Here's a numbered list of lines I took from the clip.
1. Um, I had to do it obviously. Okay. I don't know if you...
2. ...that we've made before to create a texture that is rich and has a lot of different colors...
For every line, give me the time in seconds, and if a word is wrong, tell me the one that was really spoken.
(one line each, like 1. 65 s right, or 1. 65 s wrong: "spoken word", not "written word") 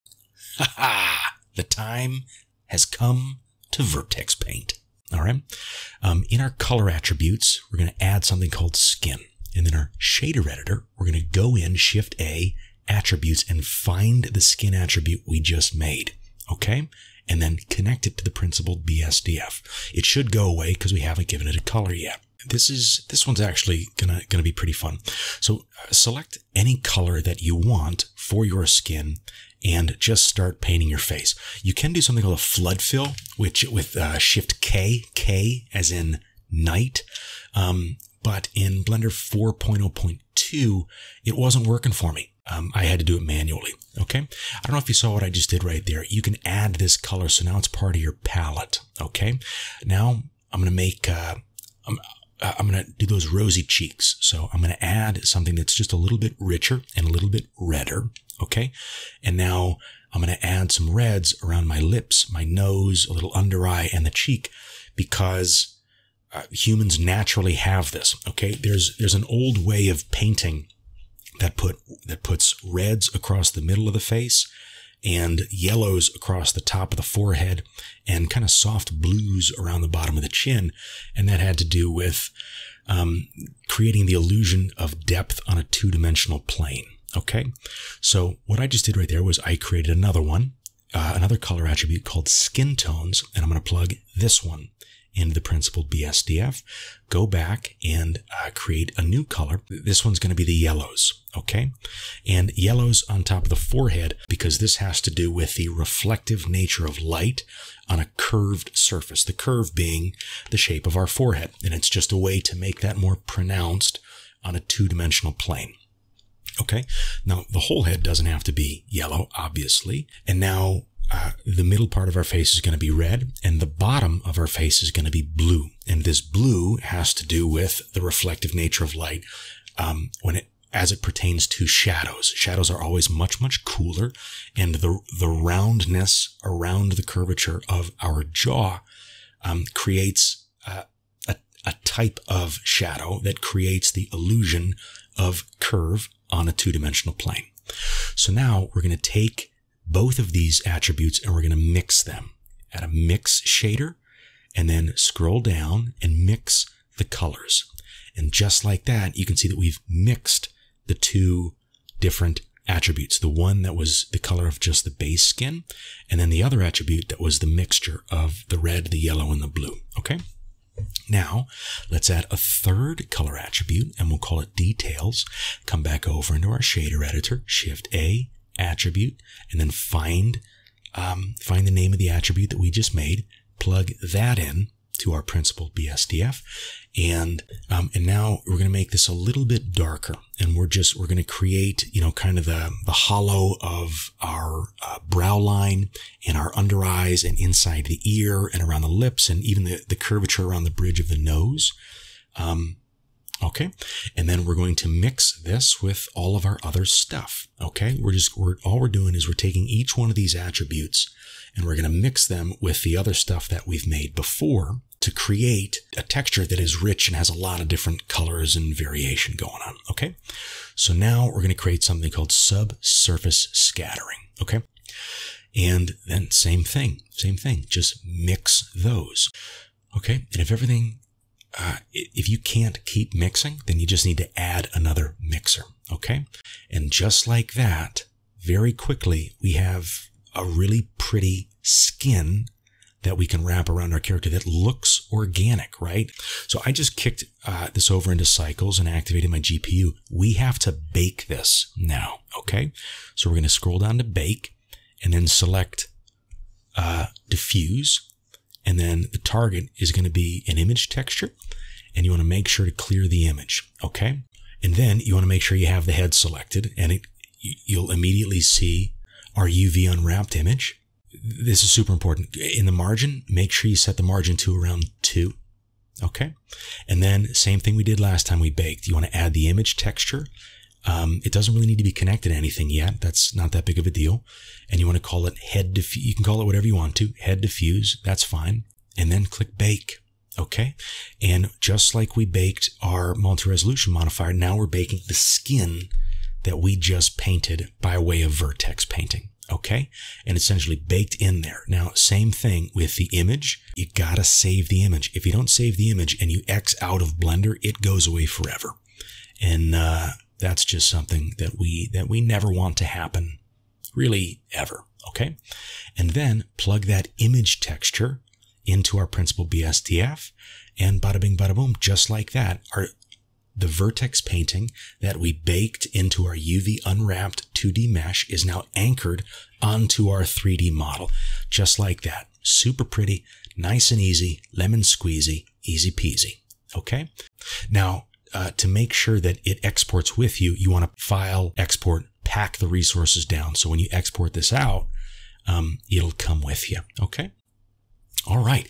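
1. 42 s wrong: "manually", not "obviously"
2. 213 s right.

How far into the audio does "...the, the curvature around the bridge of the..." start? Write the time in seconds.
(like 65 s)
199 s.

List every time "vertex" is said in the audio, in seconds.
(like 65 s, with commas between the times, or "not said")
3 s, 298 s, 323 s.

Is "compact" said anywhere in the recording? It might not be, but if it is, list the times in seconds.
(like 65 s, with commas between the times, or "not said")
not said.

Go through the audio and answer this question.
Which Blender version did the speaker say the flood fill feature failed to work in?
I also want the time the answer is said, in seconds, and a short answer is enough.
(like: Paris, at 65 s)
4.0.2, at 38 s.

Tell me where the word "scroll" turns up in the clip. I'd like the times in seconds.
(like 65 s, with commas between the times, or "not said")
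154 s, 253 s.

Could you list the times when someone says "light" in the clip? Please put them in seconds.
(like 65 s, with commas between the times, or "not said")
107 s, 128 s.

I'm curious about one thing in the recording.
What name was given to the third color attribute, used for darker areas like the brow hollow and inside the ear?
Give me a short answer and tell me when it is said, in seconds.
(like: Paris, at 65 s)
details, at 174 s.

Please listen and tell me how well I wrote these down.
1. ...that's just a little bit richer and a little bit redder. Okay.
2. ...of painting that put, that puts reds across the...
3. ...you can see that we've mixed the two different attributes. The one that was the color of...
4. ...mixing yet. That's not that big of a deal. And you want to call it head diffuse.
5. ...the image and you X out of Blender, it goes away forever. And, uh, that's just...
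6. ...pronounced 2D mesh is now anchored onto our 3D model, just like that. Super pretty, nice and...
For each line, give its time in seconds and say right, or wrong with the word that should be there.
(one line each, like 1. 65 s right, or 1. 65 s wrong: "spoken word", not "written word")
1. 55 s right
2. 69 s right
3. 159 s right
4. 282 s wrong: "anything", not "mixing"
5. 305 s right
6. 326 s wrong: "unwrapped", not "pronounced".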